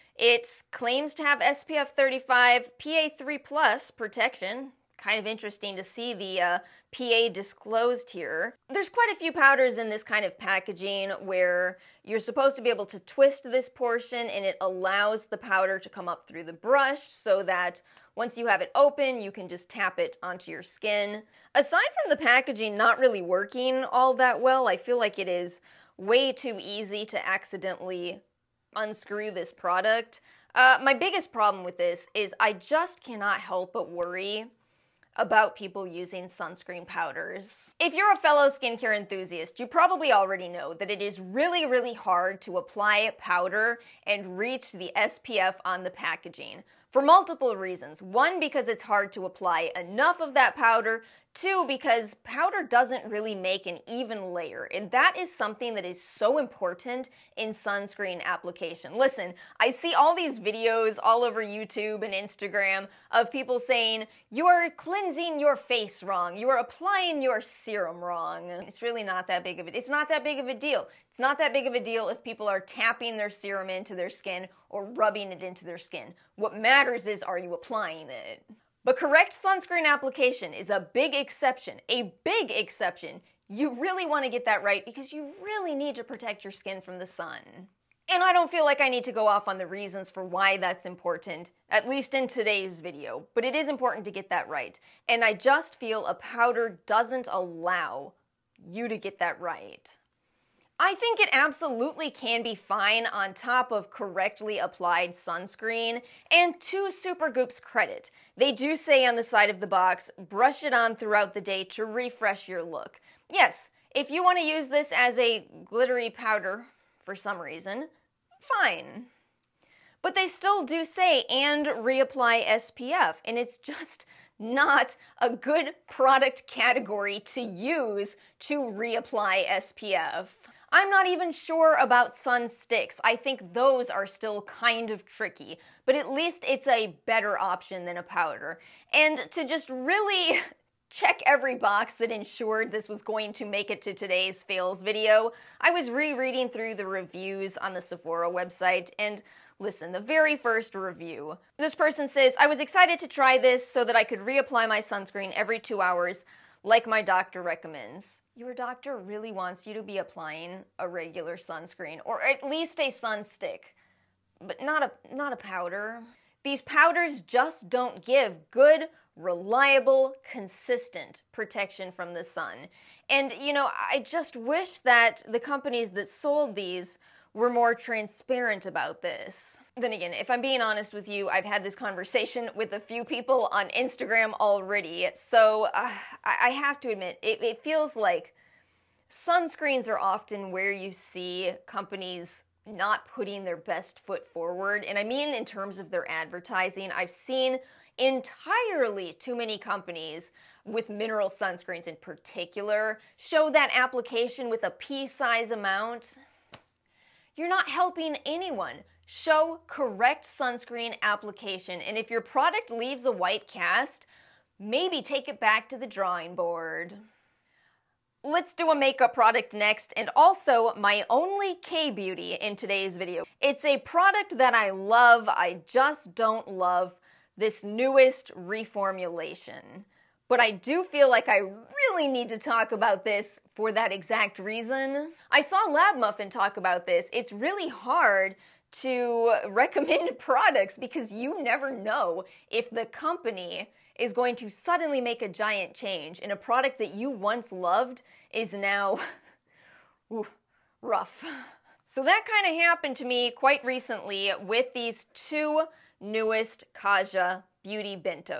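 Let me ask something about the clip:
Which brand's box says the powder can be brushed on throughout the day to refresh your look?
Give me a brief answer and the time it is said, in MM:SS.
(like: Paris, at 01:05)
Supergoop, at 01:46.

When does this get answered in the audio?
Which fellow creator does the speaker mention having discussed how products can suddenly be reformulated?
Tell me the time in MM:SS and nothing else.
03:55.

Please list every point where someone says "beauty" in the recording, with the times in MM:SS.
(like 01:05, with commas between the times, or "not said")
03:41, 04:17.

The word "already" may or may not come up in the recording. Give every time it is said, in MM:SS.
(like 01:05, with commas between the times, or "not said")
00:40, 03:04.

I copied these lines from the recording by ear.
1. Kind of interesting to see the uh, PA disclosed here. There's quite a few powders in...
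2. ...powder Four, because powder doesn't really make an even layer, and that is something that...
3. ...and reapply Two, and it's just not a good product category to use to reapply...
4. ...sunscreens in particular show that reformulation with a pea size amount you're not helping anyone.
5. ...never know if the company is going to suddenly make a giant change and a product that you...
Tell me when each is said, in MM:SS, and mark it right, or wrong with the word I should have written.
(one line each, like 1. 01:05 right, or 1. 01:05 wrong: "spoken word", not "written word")
1. 00:04 right
2. 00:50 wrong: "Two", not "Four"
3. 02:01 wrong: "SPF", not "Two"
4. 03:21 wrong: "application", not "reformulation"
5. 04:01 right.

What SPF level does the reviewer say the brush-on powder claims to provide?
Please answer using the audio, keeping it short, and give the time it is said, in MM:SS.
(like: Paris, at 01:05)
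SPF 35, at 00:01.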